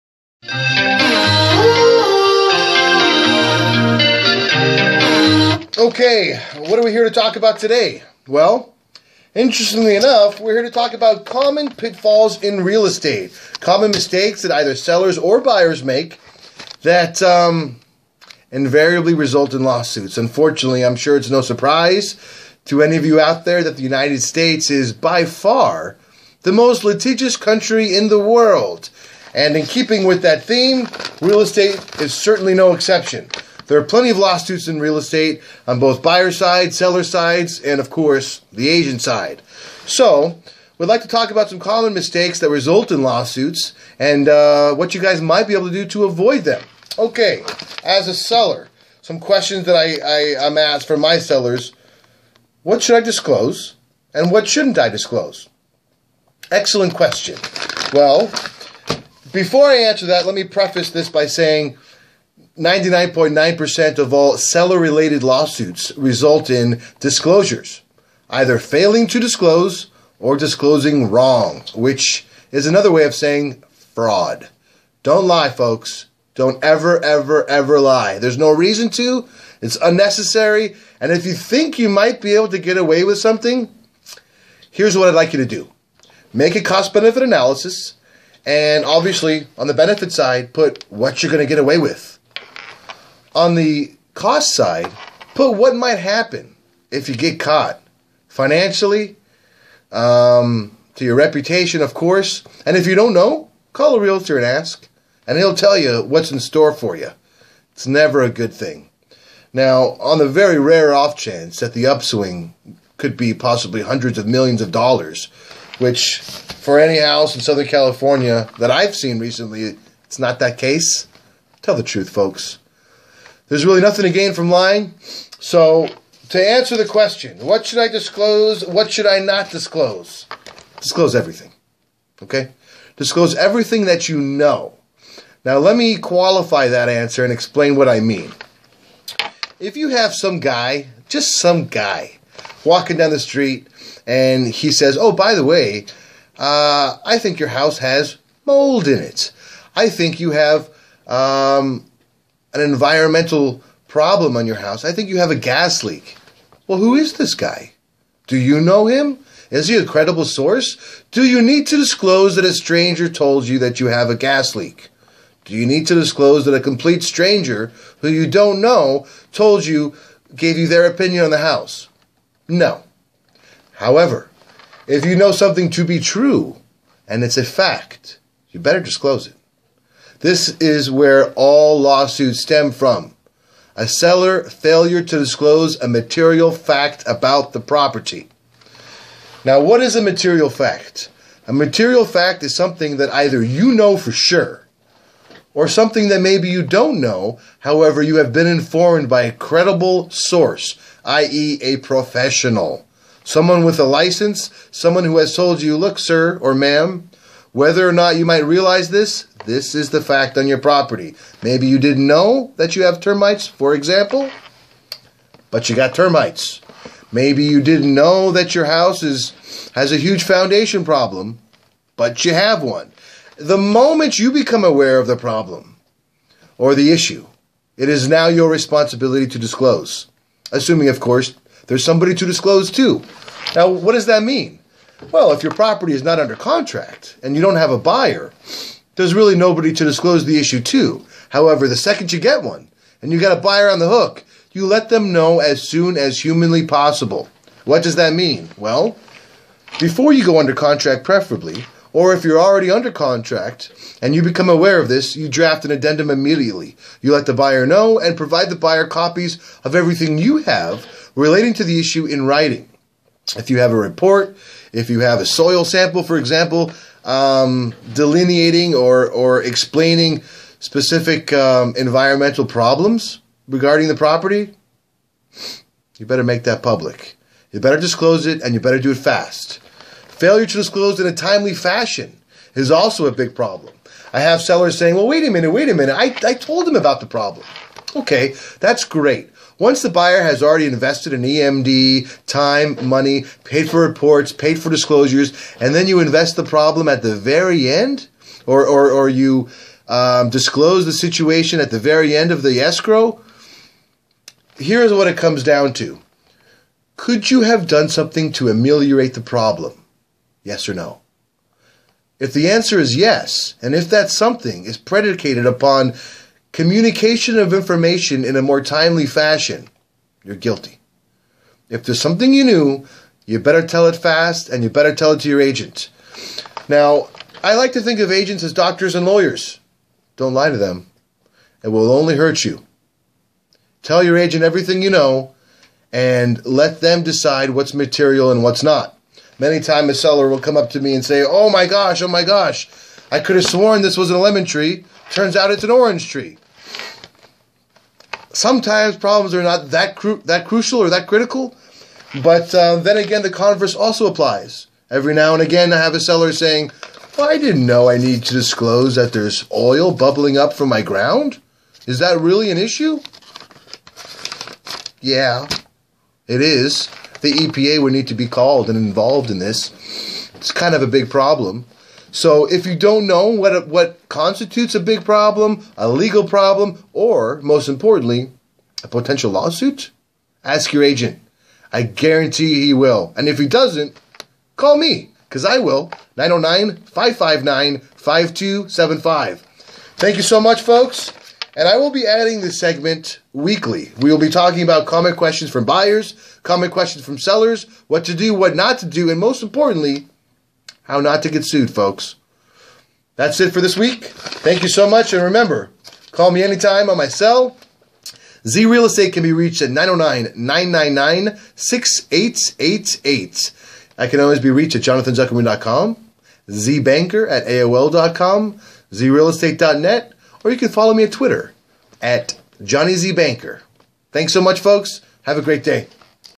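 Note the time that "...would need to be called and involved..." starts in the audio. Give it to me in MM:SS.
06:07.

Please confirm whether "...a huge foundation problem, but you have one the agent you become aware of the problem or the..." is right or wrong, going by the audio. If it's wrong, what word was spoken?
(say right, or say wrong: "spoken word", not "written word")
wrong: "moment", not "agent".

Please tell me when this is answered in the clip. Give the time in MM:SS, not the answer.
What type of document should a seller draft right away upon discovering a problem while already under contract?
04:15.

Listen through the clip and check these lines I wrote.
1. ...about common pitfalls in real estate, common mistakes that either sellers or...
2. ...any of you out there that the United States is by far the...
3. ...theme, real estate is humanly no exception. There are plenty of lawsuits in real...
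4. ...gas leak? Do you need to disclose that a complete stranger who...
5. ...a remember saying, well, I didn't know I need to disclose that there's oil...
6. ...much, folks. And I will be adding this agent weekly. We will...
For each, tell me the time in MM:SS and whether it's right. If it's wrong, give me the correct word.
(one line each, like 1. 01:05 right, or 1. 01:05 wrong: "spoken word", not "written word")
1. 00:10 right
2. 00:22 right
3. 00:30 wrong: "certainly", not "humanly"
4. 02:44 right
5. 05:55 wrong: "seller", not "remember"
6. 06:30 wrong: "segment", not "agent".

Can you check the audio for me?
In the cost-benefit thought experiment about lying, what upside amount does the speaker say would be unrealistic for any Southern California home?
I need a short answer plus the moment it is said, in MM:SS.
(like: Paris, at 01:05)
hundreds of millions of dollars, at 01:53.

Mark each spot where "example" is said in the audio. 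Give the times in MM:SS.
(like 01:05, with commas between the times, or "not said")
03:33, 04:26.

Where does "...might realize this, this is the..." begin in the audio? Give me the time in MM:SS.
03:28.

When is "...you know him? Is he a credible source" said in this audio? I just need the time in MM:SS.
02:38.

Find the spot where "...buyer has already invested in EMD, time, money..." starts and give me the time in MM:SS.
04:49.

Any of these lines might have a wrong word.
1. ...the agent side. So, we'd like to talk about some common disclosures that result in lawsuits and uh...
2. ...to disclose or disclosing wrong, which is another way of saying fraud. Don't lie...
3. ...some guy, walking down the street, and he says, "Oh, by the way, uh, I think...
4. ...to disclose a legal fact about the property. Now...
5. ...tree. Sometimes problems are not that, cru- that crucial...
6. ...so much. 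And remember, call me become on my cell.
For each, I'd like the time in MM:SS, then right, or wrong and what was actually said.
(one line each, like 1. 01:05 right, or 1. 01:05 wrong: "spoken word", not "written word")
1. 00:38 wrong: "mistakes", not "disclosures"
2. 01:09 right
3. 02:21 right
4. 03:05 wrong: "material", not "legal"
5. 05:46 right
6. 06:44 wrong: "anytime", not "become".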